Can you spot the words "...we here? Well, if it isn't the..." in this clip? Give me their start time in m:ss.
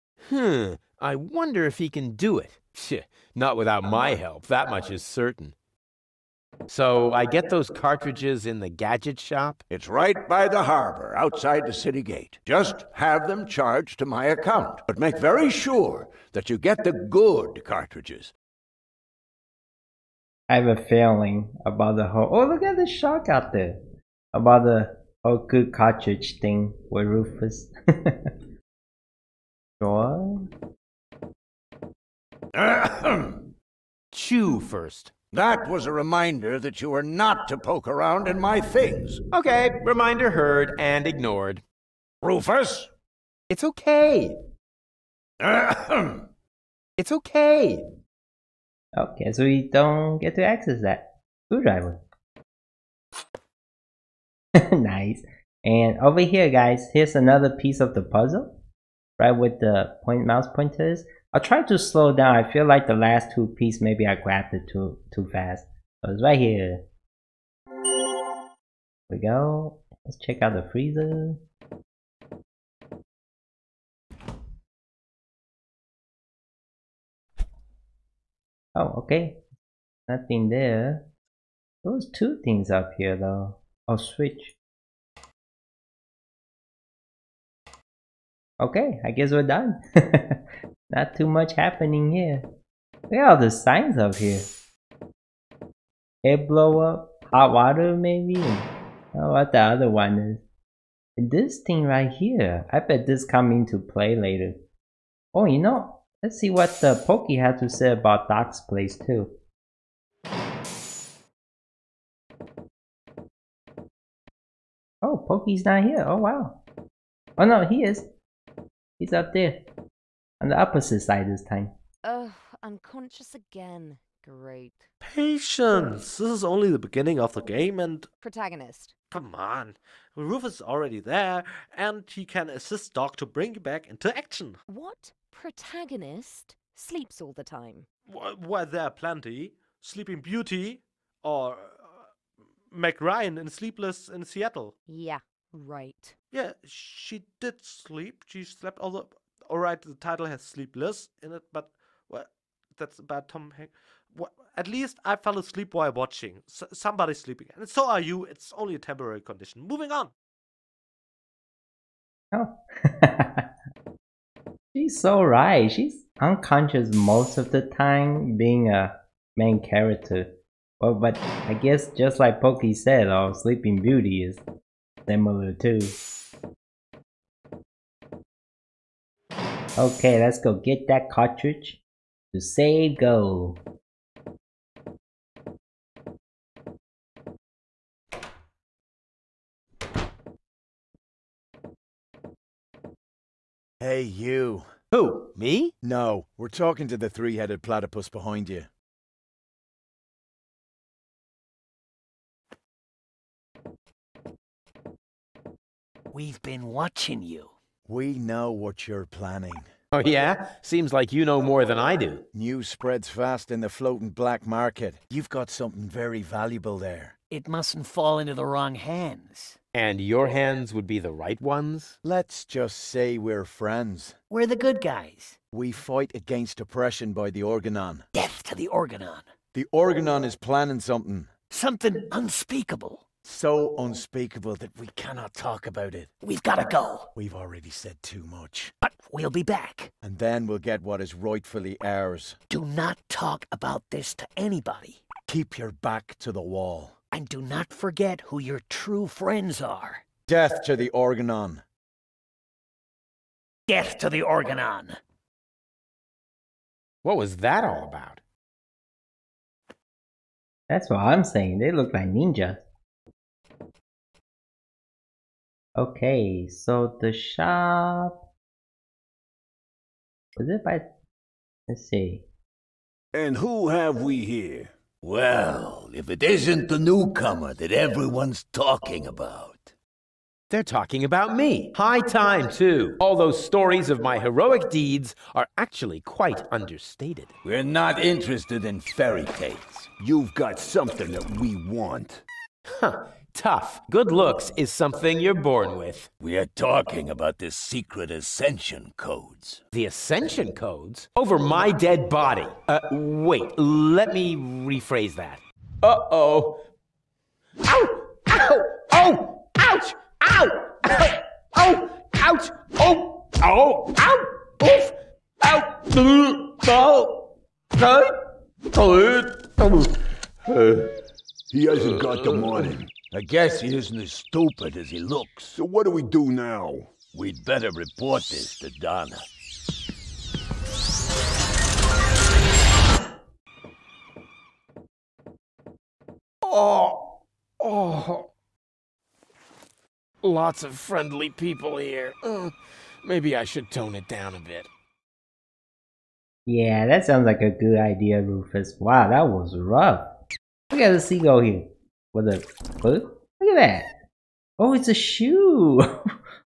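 4:34.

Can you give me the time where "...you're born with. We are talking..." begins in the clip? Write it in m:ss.
4:55.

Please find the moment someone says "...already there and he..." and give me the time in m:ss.
2:10.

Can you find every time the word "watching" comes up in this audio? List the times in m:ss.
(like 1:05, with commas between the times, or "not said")
2:35, 3:26.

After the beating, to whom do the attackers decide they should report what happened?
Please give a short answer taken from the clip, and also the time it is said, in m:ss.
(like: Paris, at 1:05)
Donna, at 5:28.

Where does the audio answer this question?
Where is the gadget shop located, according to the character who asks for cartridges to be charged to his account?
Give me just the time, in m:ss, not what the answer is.
0:09.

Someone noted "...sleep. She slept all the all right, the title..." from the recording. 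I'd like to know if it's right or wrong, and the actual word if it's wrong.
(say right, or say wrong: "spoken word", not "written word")
right.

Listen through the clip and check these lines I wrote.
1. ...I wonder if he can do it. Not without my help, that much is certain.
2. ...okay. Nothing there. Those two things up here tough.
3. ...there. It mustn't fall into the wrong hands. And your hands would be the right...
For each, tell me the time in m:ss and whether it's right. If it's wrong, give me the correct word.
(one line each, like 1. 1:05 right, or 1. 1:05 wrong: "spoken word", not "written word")
1. 0:01 right
2. 1:18 wrong: "though", not "tough"
3. 3:36 right.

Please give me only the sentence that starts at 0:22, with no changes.
Oh, look at the shark out there!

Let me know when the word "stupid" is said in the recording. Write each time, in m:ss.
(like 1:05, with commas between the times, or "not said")
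5:24.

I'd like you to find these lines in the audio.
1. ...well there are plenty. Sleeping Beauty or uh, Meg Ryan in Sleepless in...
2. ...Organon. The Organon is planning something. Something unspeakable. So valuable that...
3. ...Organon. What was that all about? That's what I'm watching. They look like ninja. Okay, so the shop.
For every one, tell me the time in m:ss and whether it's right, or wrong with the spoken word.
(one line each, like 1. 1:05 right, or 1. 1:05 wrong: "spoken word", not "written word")
1. 2:18 right
2. 3:48 wrong: "unspeakable", not "valuable"
3. 4:14 wrong: "saying", not "watching".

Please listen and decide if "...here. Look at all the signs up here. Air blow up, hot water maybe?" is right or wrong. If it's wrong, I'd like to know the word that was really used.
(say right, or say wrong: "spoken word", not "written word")
right.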